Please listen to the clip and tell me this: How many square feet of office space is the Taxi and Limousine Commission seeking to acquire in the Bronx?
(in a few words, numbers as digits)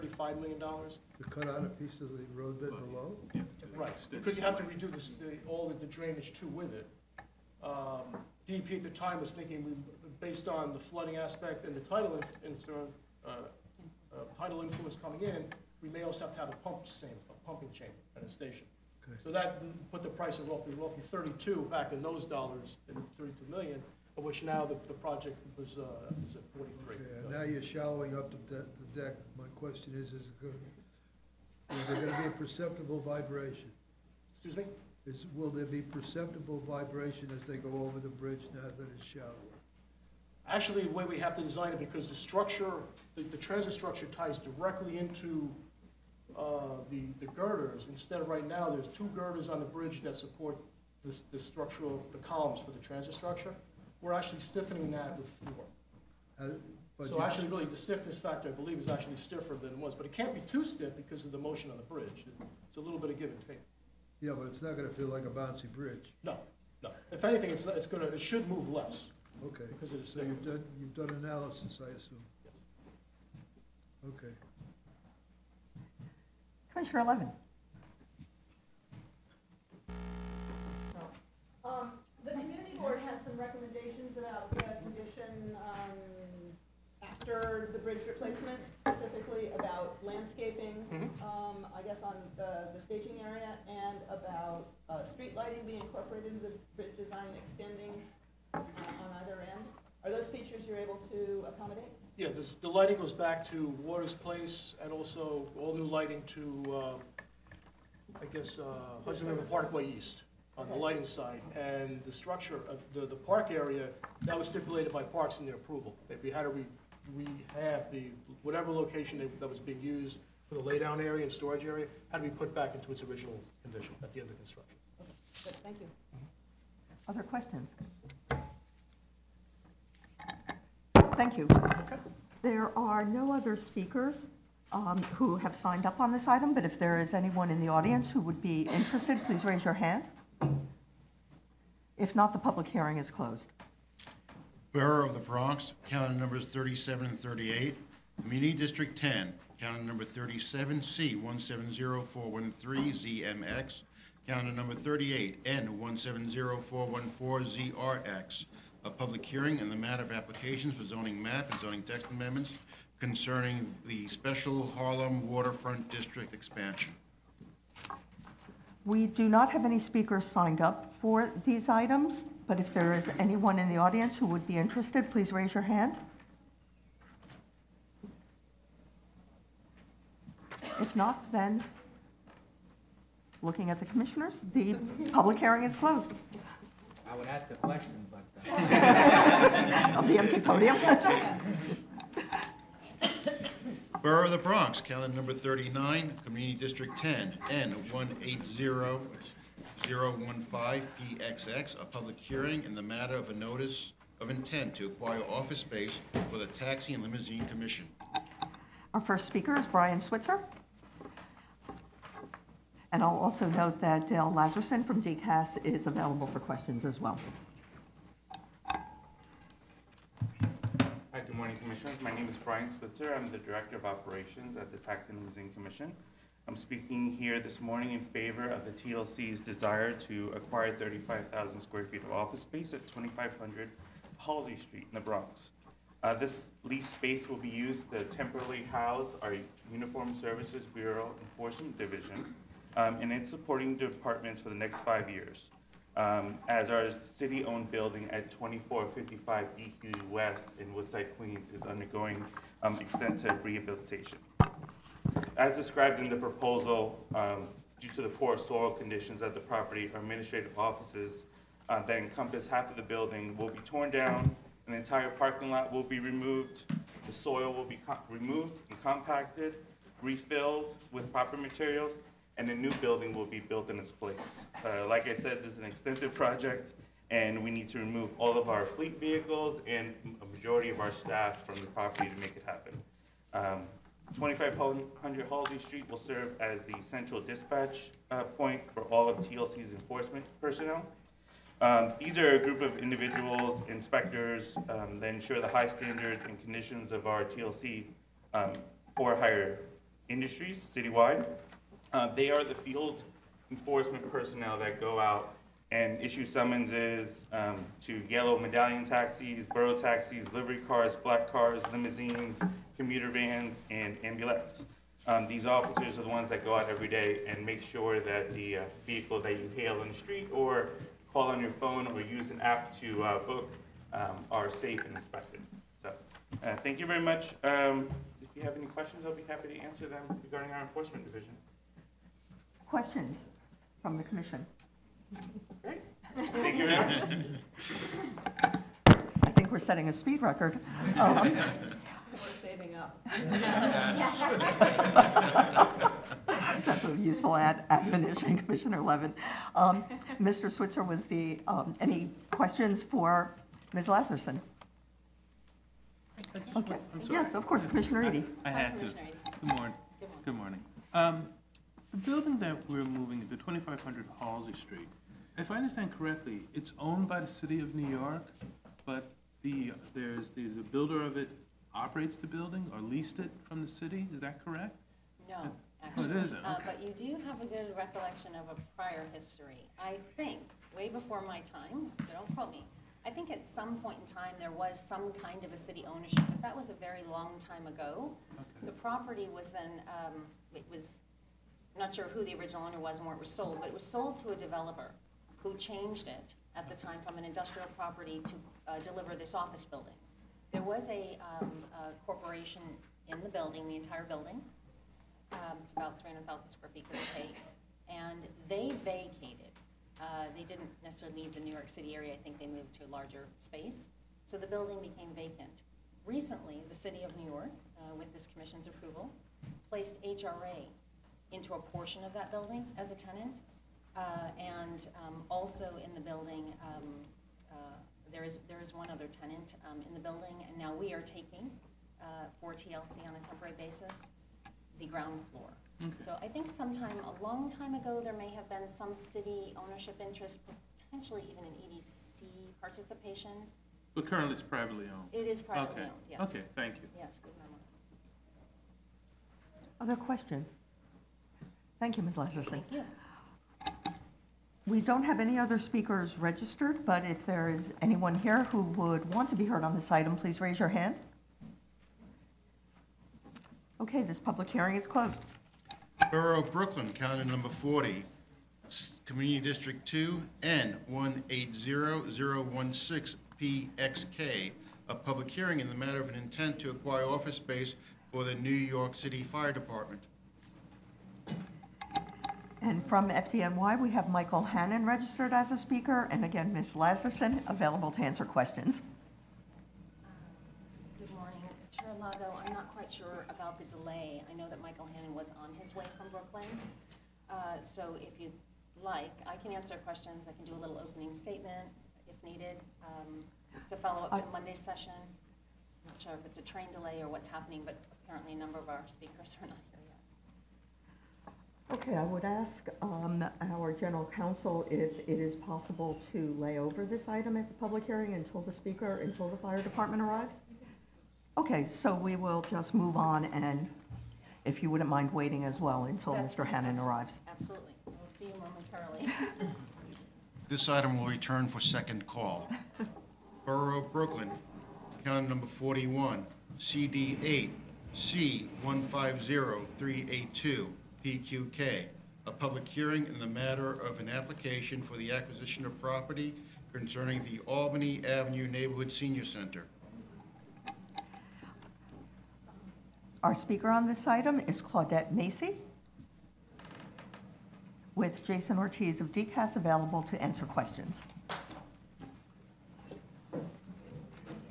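35,000.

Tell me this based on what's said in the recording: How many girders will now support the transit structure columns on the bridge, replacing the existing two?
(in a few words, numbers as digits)
4.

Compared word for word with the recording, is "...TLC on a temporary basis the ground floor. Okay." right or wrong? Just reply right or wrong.
right.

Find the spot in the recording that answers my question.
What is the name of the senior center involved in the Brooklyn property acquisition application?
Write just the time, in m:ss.
9:07.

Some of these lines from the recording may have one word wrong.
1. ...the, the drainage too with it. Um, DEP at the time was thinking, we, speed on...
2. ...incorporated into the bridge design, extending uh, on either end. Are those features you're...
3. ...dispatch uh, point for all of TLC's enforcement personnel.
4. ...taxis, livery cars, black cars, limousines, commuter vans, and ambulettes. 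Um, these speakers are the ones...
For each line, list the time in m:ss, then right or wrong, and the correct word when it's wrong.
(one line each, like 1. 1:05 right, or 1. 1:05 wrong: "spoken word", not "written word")
1. 0:05 wrong: "based", not "speed"
2. 1:35 right
3. 4:47 right
4. 5:09 wrong: "officers", not "speakers".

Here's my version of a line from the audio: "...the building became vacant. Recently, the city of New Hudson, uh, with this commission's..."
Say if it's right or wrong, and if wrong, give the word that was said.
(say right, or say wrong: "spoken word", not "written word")
wrong: "York", not "Hudson".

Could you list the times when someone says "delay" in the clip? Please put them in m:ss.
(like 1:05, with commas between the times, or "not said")
8:13, 8:26.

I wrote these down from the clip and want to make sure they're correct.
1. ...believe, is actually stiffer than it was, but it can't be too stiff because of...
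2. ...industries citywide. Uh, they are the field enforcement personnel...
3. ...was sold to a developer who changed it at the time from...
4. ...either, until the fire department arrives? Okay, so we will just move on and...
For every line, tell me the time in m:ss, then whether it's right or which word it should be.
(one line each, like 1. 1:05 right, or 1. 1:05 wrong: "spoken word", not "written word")
1. 0:58 right
2. 5:00 right
3. 6:33 right
4. 8:38 wrong: "speaker", not "either".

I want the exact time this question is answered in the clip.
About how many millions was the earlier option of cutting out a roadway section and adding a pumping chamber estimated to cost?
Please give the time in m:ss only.
0:23.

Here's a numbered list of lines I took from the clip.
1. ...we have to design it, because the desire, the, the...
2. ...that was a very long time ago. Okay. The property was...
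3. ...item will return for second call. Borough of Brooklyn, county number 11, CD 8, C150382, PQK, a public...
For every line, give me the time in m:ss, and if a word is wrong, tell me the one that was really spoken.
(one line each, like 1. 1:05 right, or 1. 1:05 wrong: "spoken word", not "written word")
1. 0:41 wrong: "structure", not "desire"
2. 6:26 right
3. 8:50 wrong: "41", not "11".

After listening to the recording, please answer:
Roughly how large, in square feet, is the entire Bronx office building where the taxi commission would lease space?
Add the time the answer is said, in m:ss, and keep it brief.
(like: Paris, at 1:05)
300,000, at 6:46.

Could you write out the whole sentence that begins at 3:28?
Our first speaker is Brian Switzer.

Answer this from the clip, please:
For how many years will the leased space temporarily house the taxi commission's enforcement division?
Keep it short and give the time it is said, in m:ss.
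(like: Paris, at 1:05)
5, at 4:04.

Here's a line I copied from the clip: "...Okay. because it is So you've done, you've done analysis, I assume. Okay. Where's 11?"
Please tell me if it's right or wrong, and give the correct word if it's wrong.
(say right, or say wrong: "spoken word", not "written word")
right.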